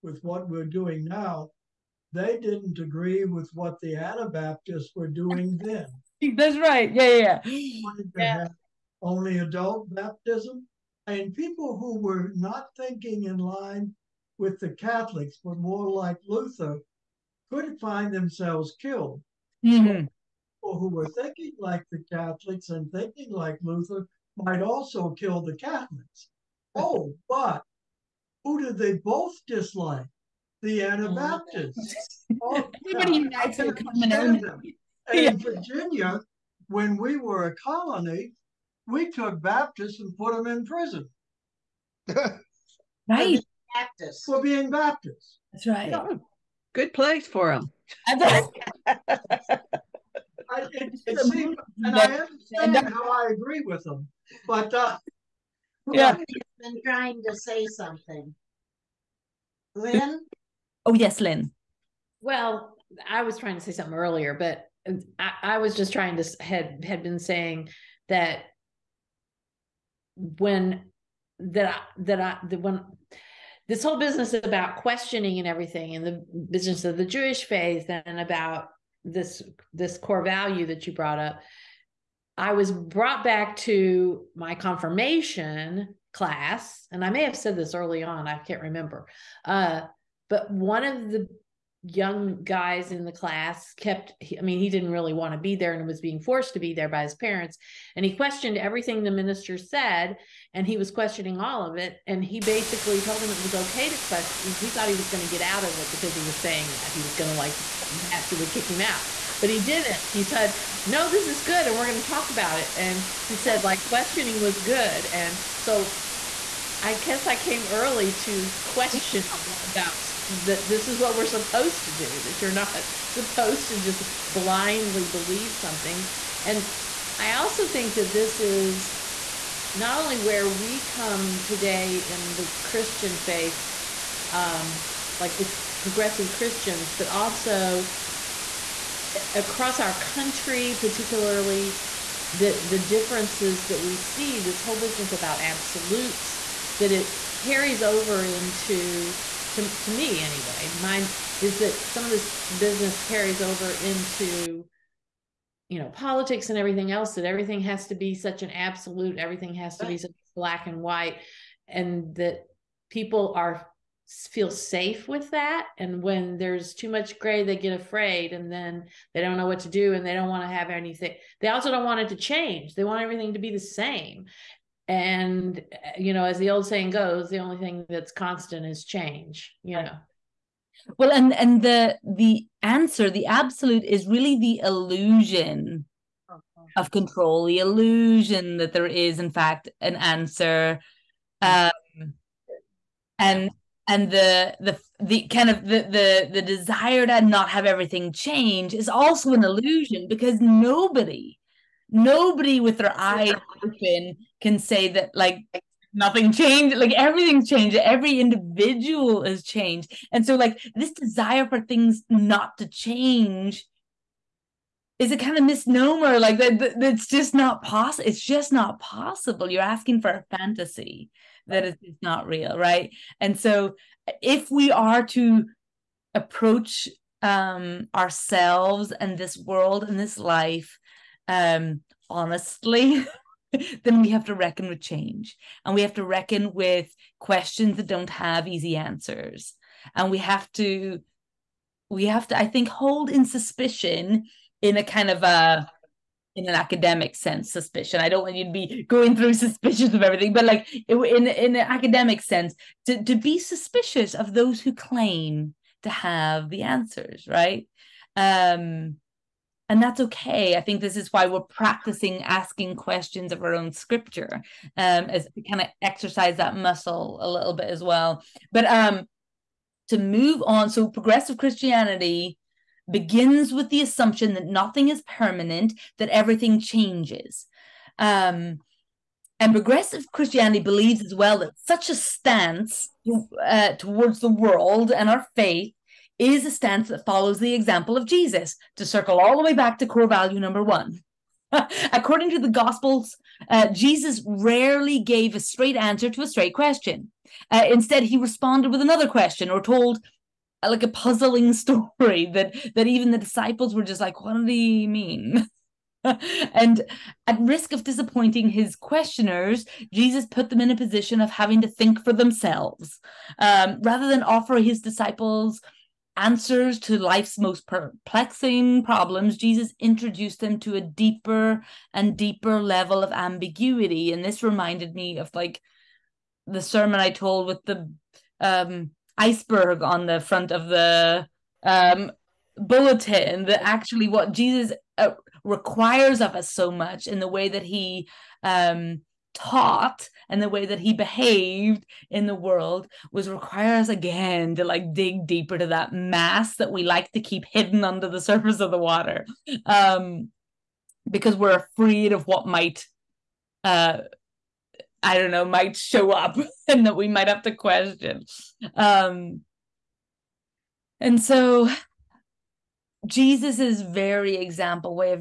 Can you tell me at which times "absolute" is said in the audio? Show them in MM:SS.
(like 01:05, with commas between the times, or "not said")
02:25, 02:38, 03:03.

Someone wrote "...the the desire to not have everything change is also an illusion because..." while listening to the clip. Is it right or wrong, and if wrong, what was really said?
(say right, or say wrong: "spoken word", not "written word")
right.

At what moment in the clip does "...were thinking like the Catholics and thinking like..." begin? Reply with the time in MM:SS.
00:20.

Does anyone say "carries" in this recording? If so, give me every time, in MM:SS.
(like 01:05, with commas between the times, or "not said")
02:27, 02:33.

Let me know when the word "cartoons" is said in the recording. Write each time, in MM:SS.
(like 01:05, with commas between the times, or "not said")
not said.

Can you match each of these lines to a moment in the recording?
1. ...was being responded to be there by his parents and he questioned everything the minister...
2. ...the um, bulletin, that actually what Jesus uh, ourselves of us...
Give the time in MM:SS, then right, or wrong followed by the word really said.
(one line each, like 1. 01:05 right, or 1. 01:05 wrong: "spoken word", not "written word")
1. 01:35 wrong: "forced", not "responded"
2. 05:30 wrong: "requires", not "ourselves".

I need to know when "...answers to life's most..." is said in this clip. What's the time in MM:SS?
05:16.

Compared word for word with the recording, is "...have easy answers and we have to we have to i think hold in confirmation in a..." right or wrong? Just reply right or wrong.
wrong.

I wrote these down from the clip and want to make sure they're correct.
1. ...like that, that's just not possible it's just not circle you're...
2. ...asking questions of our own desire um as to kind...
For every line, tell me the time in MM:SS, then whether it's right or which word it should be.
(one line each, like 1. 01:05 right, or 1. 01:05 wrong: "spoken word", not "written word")
1. 03:36 wrong: "possible", not "circle"
2. 04:22 wrong: "scripture", not "desire".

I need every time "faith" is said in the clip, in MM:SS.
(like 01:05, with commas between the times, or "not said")
01:17, 02:13, 04:45.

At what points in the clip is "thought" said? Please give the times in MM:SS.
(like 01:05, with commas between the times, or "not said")
01:44.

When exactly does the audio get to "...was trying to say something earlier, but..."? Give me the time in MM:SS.
01:03.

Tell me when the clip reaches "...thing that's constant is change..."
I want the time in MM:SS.
02:57.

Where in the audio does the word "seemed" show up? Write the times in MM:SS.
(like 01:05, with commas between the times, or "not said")
00:51.